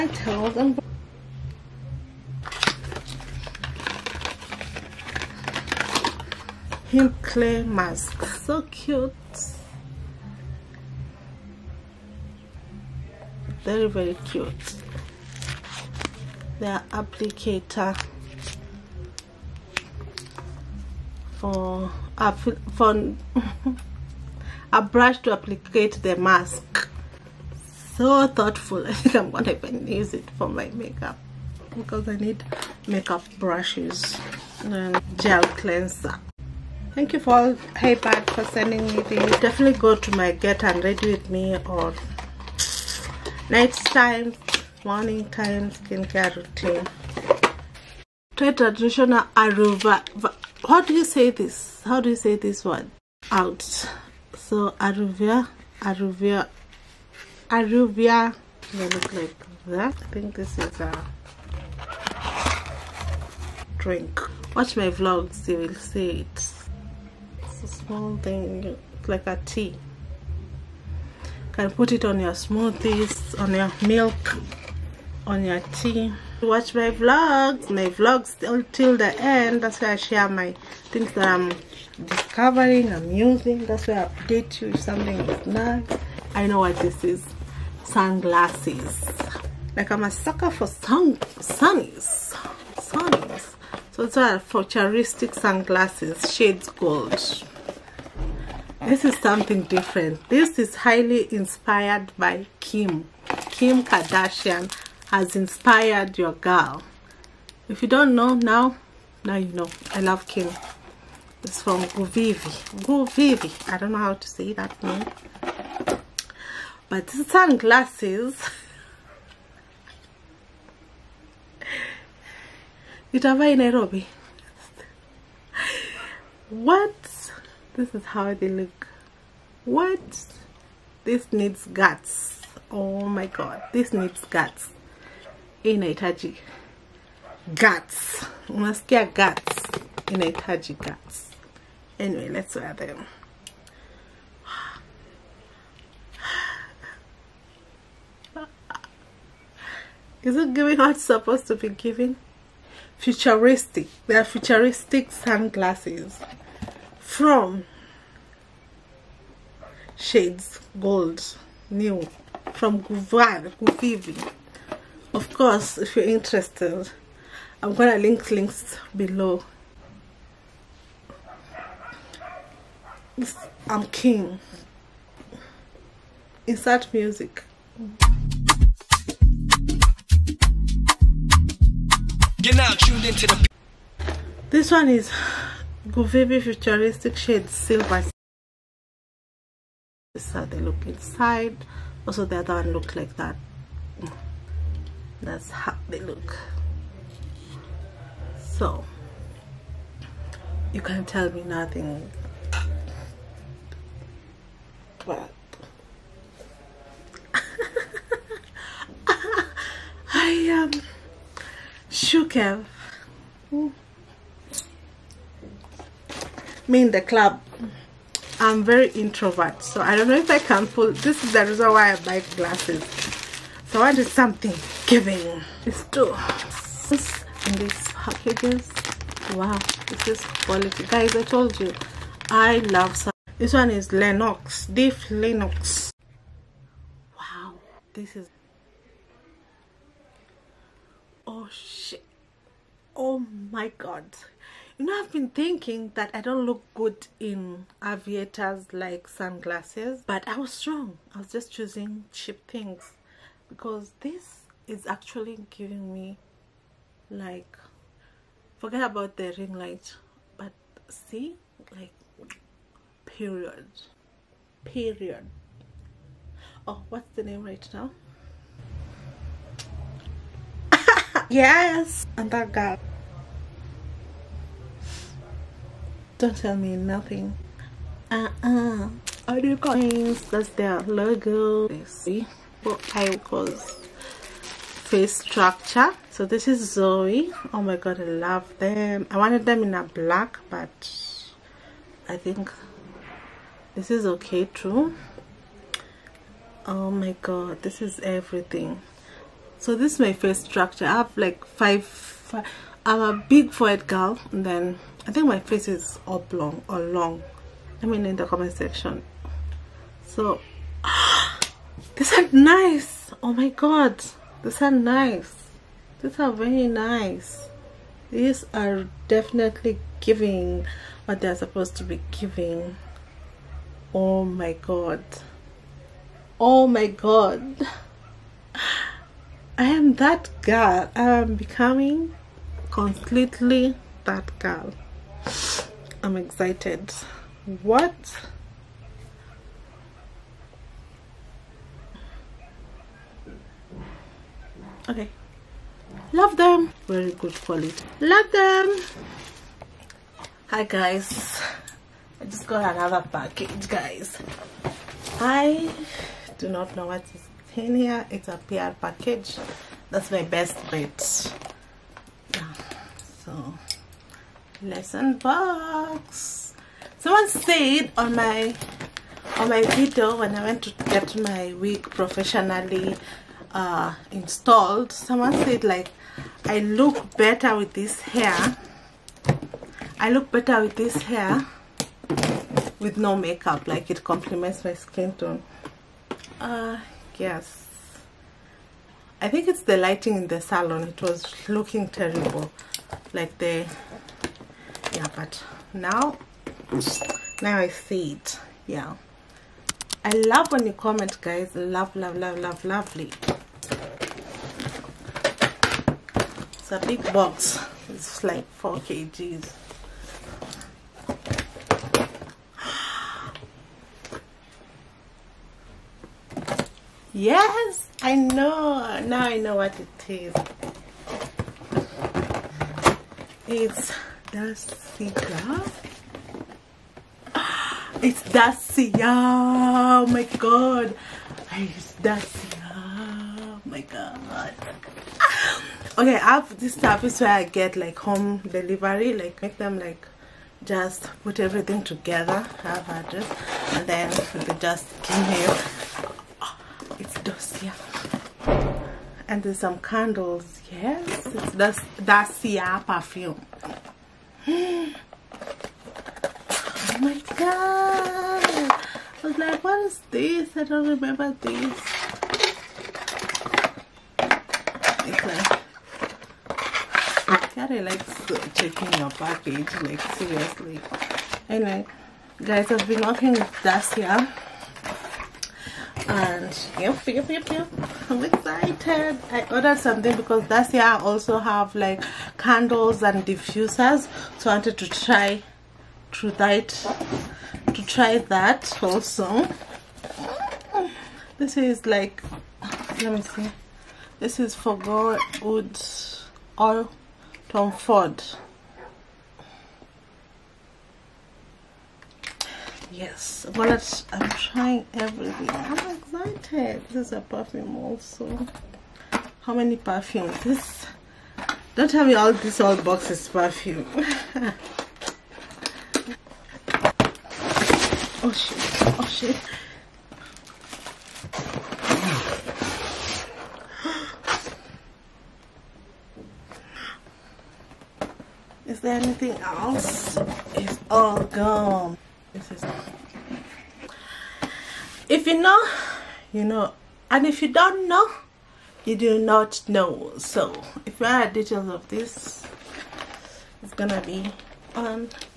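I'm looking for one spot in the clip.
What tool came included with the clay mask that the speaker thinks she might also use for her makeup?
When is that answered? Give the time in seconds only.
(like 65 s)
24 s.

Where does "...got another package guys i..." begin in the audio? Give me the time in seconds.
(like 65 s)
352 s.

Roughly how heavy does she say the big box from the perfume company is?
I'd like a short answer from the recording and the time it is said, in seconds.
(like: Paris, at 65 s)
4 kg, at 408 s.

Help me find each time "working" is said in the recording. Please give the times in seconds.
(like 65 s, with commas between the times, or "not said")
473 s.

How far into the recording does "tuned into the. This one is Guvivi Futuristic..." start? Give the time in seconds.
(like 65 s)
183 s.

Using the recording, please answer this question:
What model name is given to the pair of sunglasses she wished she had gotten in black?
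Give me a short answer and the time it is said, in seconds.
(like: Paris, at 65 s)
Zoe, at 286 s.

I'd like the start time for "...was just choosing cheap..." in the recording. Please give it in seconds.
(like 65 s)
251 s.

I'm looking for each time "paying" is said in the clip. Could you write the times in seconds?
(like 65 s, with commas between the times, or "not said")
not said.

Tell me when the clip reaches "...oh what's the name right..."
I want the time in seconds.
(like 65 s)
266 s.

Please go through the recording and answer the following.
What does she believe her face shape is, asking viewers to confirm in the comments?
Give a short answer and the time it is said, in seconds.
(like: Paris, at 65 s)
Oblong, at 306 s.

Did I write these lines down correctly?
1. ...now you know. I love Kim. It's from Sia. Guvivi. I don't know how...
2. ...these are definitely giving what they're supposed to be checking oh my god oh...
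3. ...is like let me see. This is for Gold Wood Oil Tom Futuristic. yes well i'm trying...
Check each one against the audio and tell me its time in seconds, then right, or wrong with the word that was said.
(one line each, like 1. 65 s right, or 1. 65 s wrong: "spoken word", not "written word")
1. 109 s wrong: "Guvivi", not "Sia"
2. 318 s wrong: "giving", not "checking"
3. 491 s wrong: "Ford", not "Futuristic".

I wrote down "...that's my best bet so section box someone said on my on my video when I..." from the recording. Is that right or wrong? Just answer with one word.
wrong.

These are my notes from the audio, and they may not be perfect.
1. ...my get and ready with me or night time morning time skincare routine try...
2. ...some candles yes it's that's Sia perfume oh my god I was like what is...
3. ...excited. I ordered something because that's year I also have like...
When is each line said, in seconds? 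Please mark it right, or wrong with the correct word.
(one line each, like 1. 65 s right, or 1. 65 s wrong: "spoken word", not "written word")
1. 40 s right
2. 449 s right
3. 478 s right.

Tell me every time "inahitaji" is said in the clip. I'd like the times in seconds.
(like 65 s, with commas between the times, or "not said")
135 s, 140 s.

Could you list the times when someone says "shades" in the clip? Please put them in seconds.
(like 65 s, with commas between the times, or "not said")
96 s, 159 s, 187 s.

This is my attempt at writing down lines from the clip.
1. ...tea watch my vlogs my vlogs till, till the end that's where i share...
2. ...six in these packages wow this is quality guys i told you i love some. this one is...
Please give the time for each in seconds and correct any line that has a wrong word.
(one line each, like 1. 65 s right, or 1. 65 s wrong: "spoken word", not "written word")
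1. 75 s right
2. 225 s wrong: "two", not "six".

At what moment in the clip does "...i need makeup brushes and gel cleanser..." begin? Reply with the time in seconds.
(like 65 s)
32 s.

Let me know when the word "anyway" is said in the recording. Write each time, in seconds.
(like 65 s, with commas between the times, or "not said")
141 s, 471 s.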